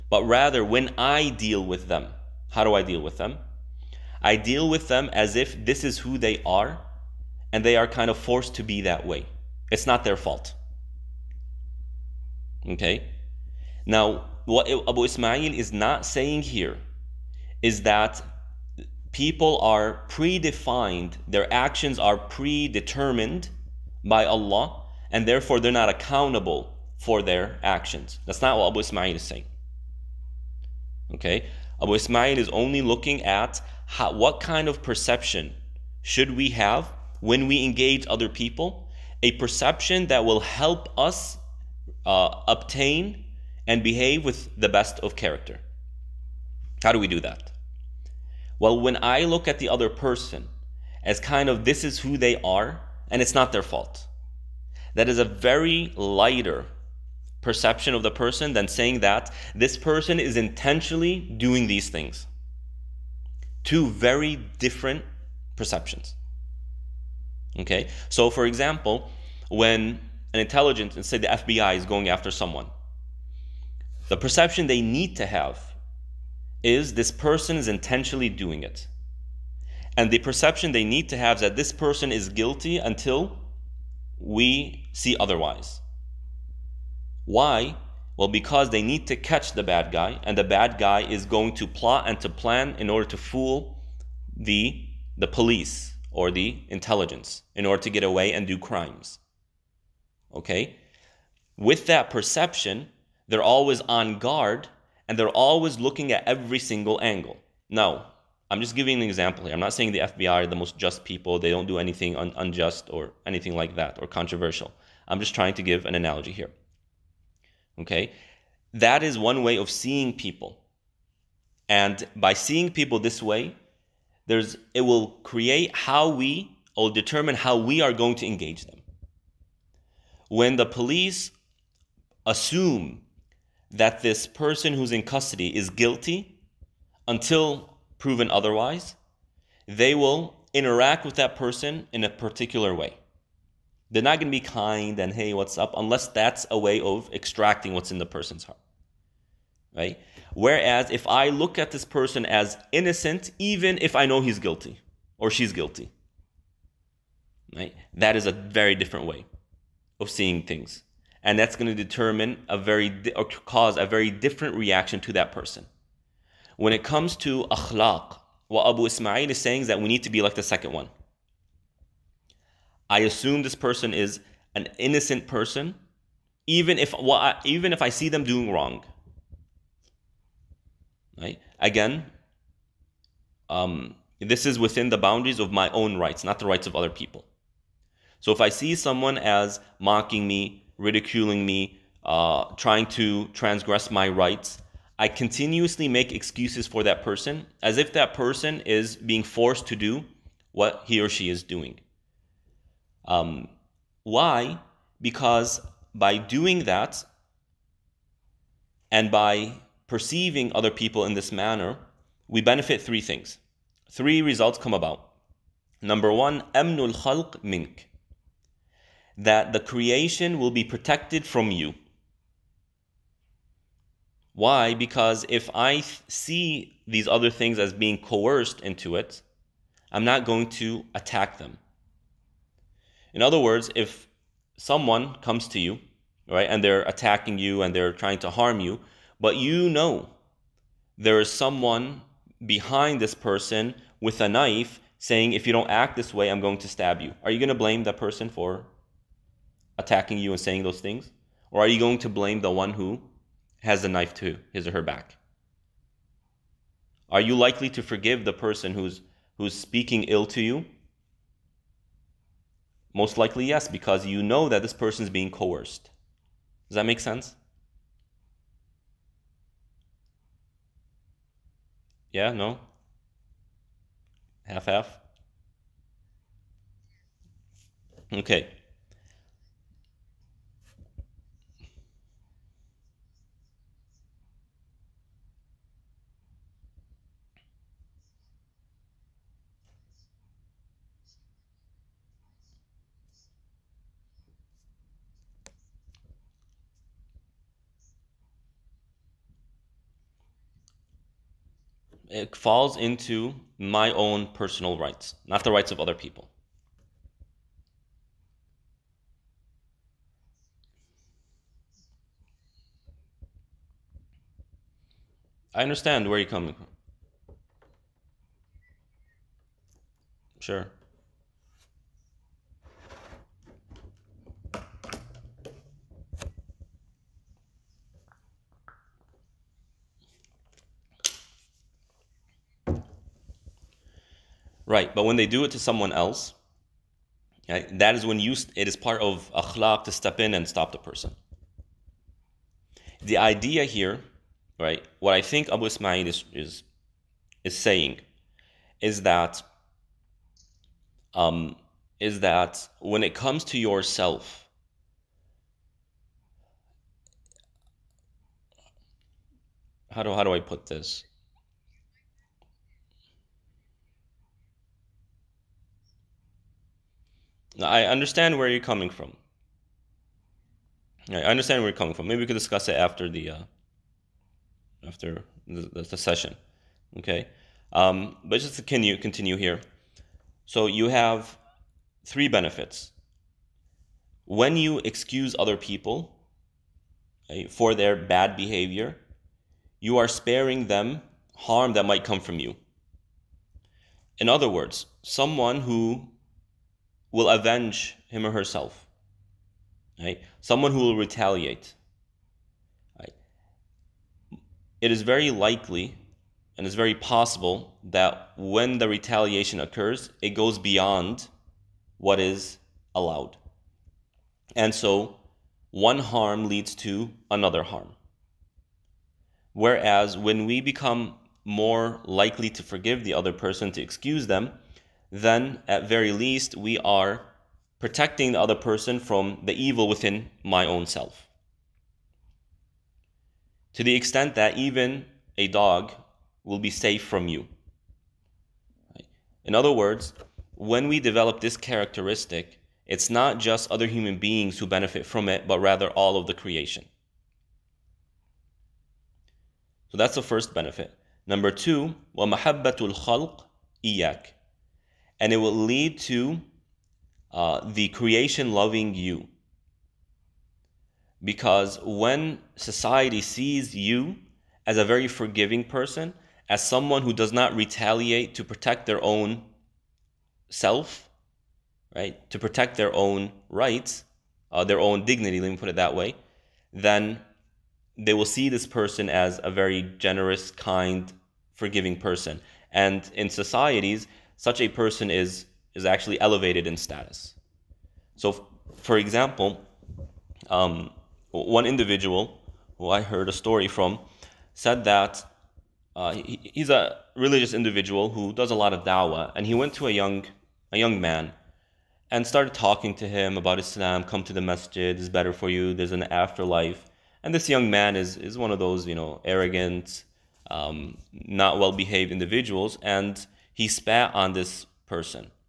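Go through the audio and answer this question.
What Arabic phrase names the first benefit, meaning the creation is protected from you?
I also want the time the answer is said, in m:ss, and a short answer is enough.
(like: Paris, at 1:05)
amnul khalq mink, at 3:36.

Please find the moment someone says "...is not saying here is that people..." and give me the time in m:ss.
0:15.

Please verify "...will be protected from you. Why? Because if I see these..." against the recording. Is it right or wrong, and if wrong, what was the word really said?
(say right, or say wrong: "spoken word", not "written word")
right.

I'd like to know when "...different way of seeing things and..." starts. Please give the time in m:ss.
2:38.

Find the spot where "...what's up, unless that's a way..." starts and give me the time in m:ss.
2:25.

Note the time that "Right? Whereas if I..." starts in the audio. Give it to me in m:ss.
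2:29.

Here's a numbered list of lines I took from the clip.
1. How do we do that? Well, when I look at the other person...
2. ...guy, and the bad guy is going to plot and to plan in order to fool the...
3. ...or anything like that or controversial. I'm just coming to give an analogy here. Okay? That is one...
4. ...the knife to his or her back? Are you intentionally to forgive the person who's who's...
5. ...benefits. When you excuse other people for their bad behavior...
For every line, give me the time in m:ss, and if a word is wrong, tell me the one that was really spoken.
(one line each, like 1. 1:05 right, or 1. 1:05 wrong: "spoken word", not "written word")
1. 0:46 right
2. 1:29 right
3. 1:52 wrong: "trying", not "coming"
4. 4:13 wrong: "likely", not "intentionally"
5. 6:22 right.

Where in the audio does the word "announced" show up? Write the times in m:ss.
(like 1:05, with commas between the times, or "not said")
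not said.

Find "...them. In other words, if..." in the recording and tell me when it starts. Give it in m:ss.
3:51.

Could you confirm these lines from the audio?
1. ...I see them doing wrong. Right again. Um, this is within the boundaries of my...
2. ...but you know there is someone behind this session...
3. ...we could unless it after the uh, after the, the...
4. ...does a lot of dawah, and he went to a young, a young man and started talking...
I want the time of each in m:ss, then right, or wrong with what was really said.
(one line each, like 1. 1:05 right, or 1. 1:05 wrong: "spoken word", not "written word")
1. 2:57 right
2. 3:59 wrong: "person", not "session"
3. 6:12 wrong: "discuss", not "unless"
4. 8:18 right.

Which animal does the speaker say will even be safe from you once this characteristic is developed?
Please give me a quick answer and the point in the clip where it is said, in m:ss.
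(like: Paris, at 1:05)
a dog, at 7:15.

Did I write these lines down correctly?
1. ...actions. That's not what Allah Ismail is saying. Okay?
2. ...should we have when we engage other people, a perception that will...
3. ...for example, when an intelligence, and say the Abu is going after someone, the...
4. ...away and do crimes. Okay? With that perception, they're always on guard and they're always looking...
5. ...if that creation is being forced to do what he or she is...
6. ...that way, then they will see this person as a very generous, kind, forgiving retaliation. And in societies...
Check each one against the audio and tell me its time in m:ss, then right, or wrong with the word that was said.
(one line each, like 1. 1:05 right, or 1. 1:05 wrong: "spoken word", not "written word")
1. 0:27 wrong: "Abu", not "Allah"
2. 0:36 right
3. 1:08 wrong: "FBI", not "Abu"
4. 1:38 right
5. 3:17 wrong: "person", not "creation"
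6. 7:55 wrong: "person", not "retaliation".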